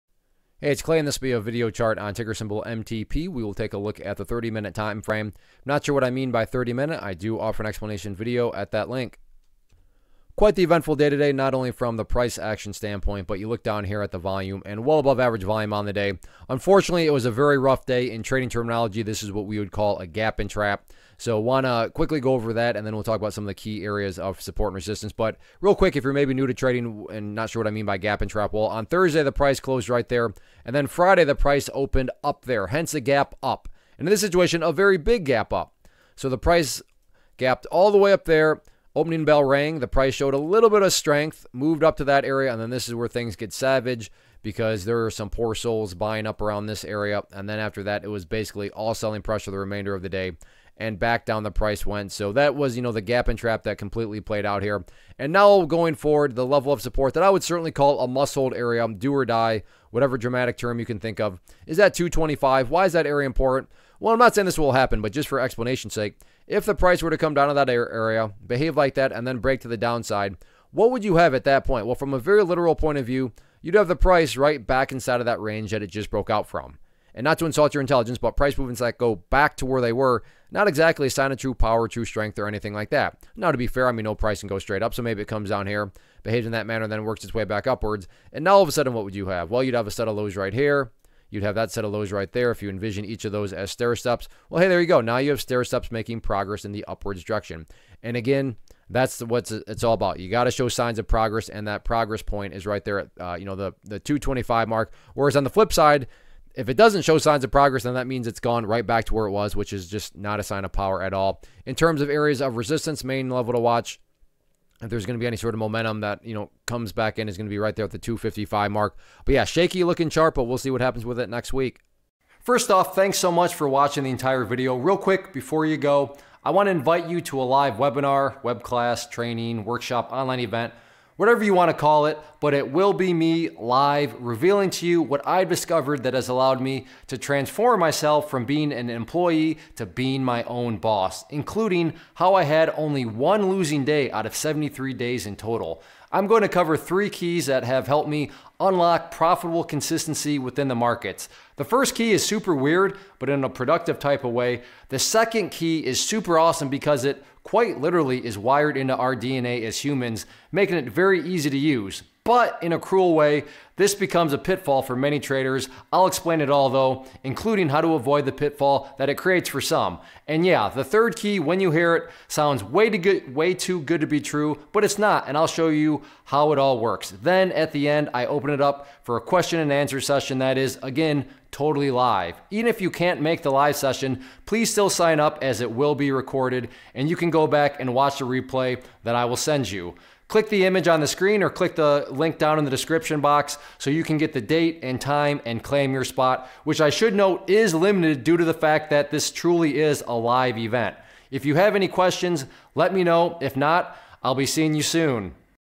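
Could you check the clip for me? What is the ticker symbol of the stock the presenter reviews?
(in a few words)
MTP.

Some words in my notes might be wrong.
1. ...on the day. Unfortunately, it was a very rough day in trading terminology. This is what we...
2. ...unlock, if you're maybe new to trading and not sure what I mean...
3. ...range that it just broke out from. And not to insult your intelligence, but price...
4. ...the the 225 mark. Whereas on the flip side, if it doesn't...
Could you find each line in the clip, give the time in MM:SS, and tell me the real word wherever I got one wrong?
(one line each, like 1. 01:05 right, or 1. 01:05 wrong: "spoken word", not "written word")
1. 00:15 right
2. 00:25 wrong: "quick", not "unlock"
3. 01:15 right
4. 01:43 right.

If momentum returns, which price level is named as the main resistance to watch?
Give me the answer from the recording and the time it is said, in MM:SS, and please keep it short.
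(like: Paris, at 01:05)
255, at 01:57.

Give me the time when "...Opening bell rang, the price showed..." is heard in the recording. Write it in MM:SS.
00:38.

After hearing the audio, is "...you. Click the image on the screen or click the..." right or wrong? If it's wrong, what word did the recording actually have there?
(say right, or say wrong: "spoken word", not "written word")
right.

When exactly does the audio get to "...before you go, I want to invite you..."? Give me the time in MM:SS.
02:05.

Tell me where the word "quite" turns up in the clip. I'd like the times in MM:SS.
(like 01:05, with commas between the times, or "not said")
00:10, 02:37.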